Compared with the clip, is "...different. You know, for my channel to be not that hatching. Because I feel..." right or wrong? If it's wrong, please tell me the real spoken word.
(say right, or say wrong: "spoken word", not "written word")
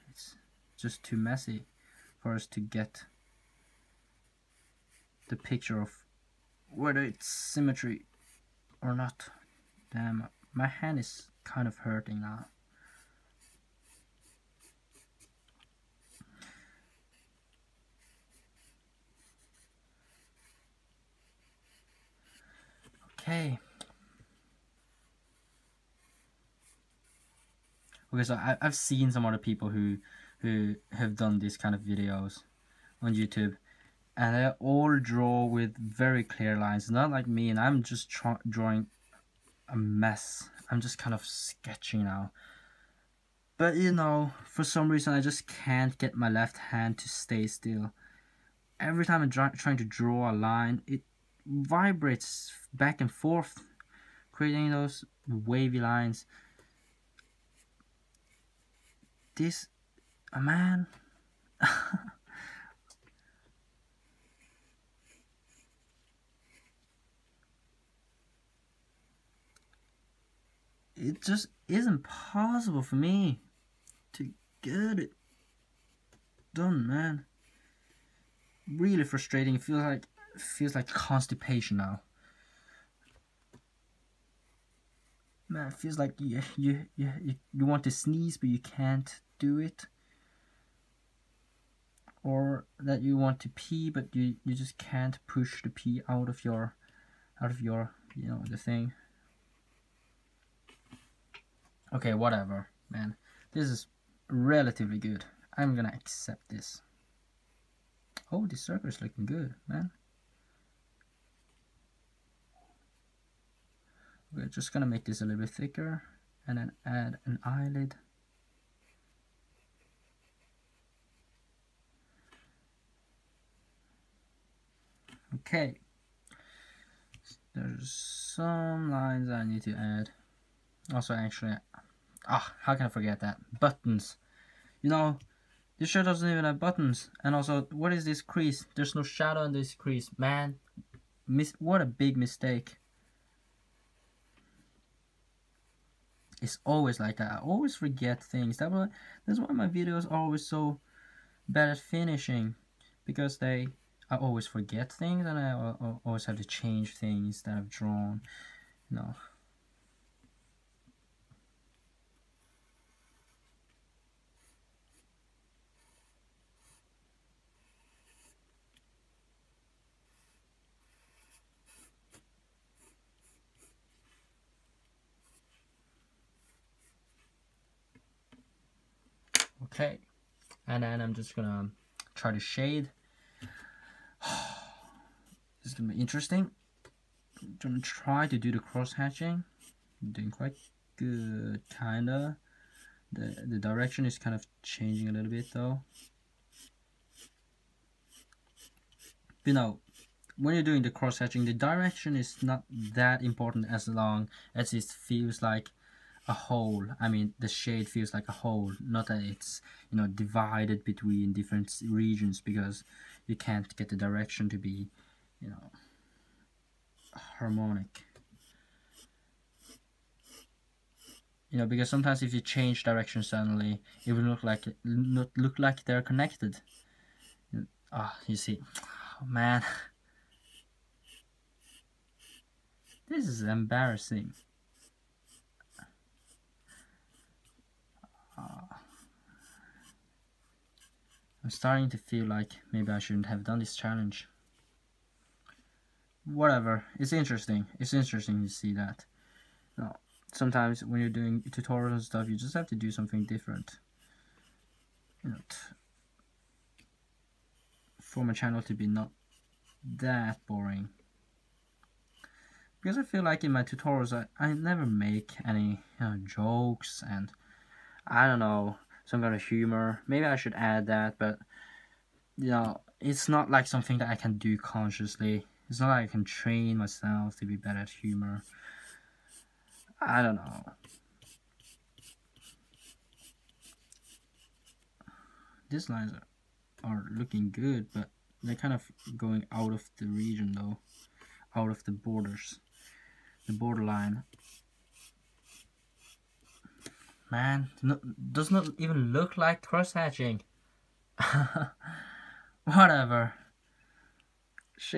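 wrong: "boring", not "hatching".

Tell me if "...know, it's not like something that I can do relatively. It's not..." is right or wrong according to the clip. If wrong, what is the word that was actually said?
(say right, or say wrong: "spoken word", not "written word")
wrong: "consciously", not "relatively".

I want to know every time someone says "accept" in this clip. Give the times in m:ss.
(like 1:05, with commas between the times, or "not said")
1:45.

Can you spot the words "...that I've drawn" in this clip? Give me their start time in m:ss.
2:37.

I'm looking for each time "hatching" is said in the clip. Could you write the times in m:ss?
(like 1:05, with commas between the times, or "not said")
3:08, 3:21, 4:59.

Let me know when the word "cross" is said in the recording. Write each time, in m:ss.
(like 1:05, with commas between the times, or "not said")
3:08, 3:20, 4:59.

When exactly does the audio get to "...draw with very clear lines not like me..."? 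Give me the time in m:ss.
0:34.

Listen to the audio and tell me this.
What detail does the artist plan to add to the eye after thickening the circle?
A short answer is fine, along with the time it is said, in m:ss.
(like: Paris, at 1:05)
An eyelid, at 1:57.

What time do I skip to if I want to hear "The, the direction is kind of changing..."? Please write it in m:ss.
3:13.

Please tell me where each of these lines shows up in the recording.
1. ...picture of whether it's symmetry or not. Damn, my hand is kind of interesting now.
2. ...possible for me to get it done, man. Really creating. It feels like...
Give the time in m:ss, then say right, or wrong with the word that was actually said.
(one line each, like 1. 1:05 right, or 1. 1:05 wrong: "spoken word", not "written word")
1. 0:05 wrong: "hurting", not "interesting"
2. 1:12 wrong: "frustrating", not "creating".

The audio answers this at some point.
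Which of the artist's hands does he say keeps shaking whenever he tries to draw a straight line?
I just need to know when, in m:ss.
0:46.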